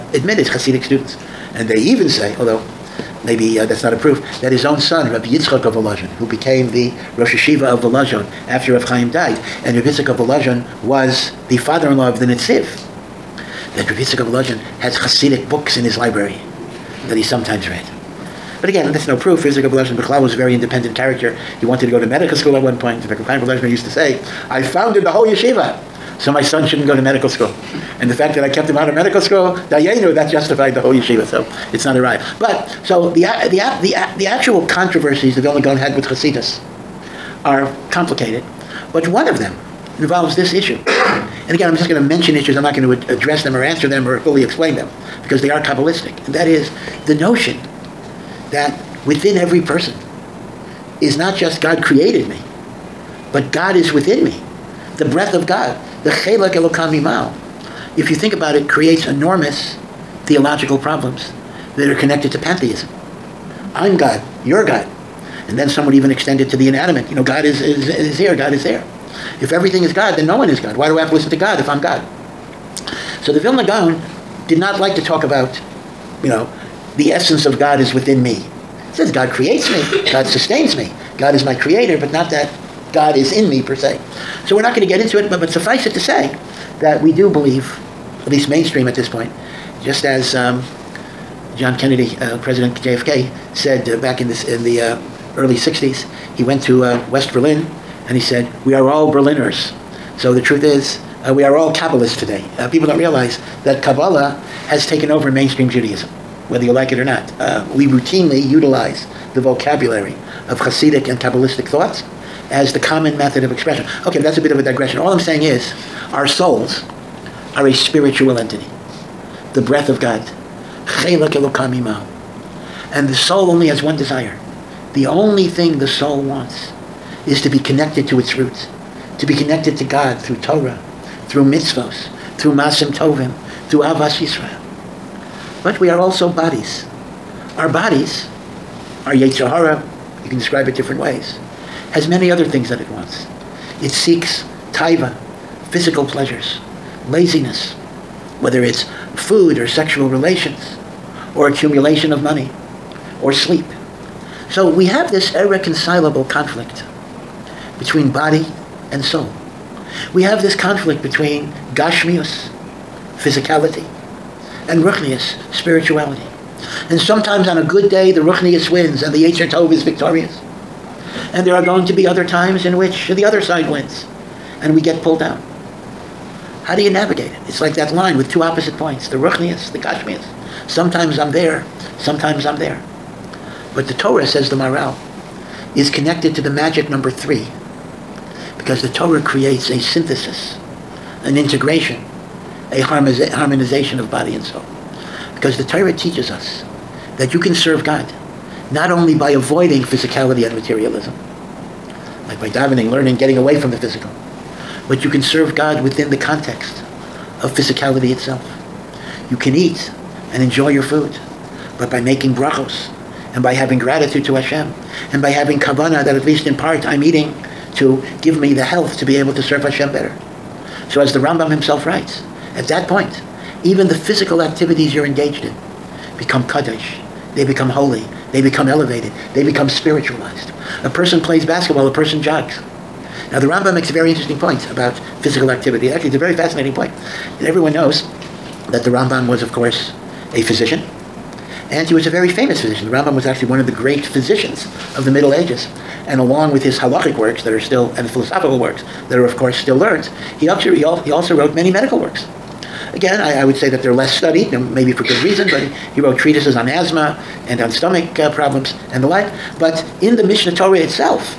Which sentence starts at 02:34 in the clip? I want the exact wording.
So we have this irreconcilable conflict between body and soul.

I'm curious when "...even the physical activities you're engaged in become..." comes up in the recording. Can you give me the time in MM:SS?
03:43.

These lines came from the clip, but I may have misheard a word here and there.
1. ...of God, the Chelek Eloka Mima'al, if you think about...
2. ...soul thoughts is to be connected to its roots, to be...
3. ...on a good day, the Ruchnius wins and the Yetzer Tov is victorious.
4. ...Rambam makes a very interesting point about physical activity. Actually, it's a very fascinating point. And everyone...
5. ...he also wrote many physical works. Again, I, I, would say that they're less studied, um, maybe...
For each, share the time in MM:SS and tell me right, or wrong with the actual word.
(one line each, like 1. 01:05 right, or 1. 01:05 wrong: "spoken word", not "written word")
1. 00:55 right
2. 02:05 wrong: "wants", not "thoughts"
3. 02:47 right
4. 03:53 right
5. 04:10 wrong: "medical", not "physical".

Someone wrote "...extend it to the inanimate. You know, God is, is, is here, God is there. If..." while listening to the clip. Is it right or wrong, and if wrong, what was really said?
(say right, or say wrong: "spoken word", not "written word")
right.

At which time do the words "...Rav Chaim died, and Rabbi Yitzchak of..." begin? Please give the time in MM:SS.
00:08.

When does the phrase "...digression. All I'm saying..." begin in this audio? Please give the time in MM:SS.
01:54.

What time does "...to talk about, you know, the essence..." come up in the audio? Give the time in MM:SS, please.
01:14.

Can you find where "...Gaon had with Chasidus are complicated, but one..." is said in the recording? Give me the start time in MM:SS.
00:35.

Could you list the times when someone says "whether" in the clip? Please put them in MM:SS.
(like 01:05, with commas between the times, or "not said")
01:46, 02:28.